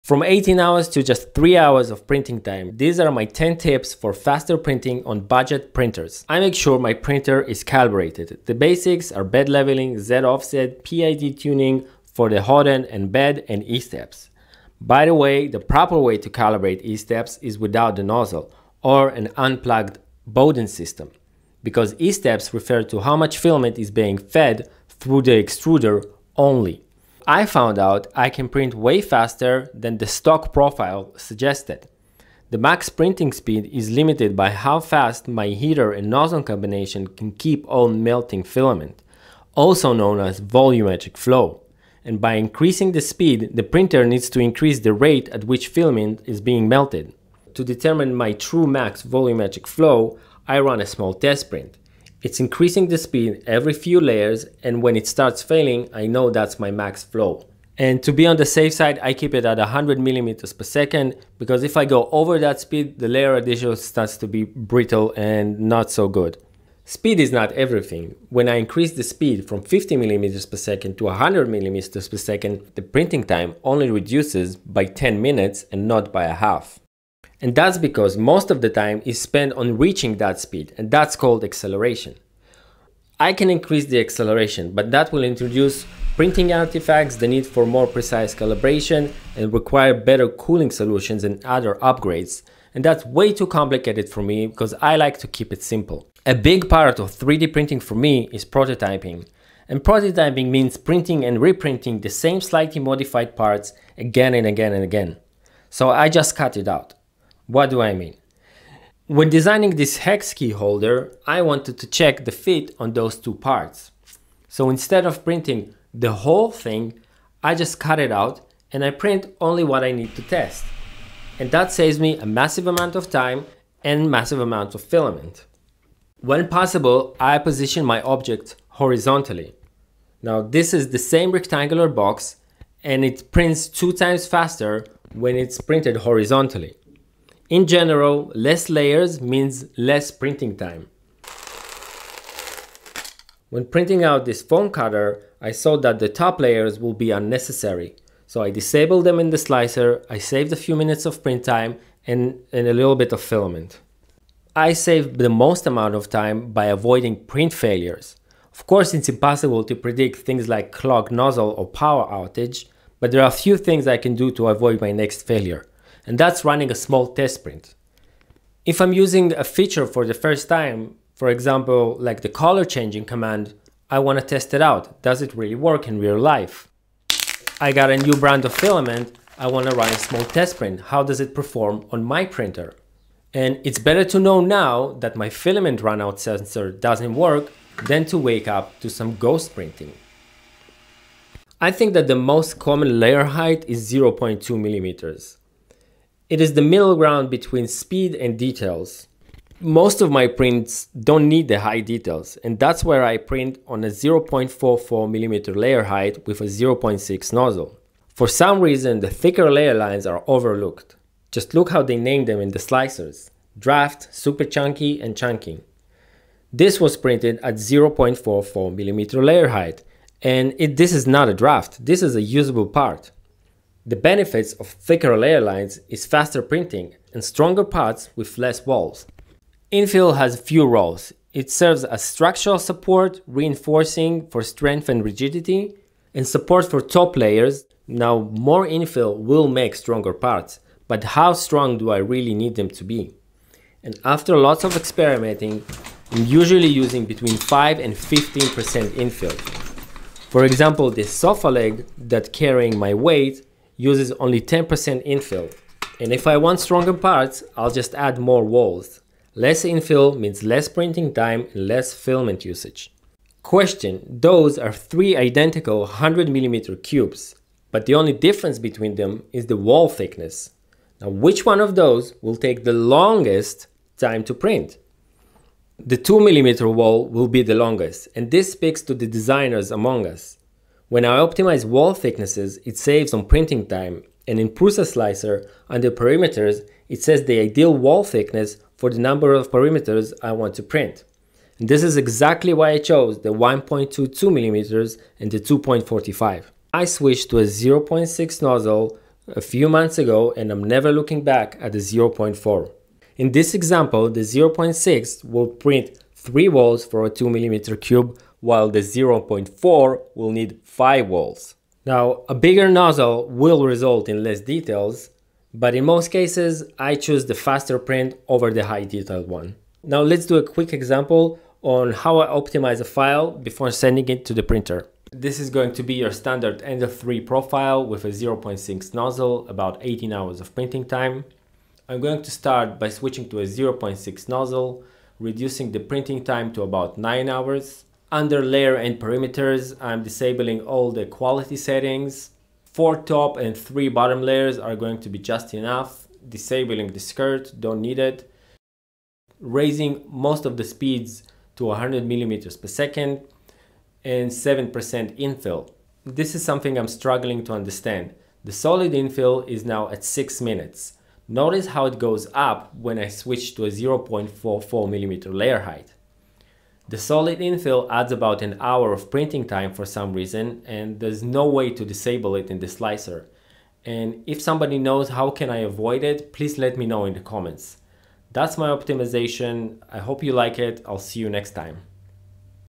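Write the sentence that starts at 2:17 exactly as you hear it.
In general, less layers means less printing time.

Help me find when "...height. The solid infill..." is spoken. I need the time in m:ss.
6:05.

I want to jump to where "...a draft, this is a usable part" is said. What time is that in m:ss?
3:41.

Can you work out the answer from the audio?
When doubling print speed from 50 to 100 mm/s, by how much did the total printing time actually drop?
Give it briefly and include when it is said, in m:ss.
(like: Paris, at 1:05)
10 minutes, at 1:14.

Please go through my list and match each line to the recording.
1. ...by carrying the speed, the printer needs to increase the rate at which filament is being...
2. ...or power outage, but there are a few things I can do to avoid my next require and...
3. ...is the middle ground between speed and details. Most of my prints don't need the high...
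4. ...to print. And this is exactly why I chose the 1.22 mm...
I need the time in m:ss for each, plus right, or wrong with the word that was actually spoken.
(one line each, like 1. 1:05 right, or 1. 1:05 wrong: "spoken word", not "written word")
1. 0:42 wrong: "increasing", not "carrying"
2. 2:41 wrong: "failure", not "require"
3. 3:16 right
4. 4:50 right.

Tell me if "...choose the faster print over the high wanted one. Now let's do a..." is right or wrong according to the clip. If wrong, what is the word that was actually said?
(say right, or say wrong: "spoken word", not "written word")
wrong: "detailed", not "wanted".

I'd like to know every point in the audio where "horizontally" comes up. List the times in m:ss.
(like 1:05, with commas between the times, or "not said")
2:08, 2:15.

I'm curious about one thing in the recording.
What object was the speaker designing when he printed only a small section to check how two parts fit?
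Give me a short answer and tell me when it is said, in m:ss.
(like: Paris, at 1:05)
hex key holder, at 1:49.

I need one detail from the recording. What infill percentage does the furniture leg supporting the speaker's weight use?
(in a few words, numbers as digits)
10%.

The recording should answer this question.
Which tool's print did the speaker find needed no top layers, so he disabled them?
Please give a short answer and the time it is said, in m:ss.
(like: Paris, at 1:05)
foam cutter, at 2:24.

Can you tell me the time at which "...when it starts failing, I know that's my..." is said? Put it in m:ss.
0:54.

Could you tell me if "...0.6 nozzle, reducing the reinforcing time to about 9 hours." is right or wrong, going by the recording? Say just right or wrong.
wrong.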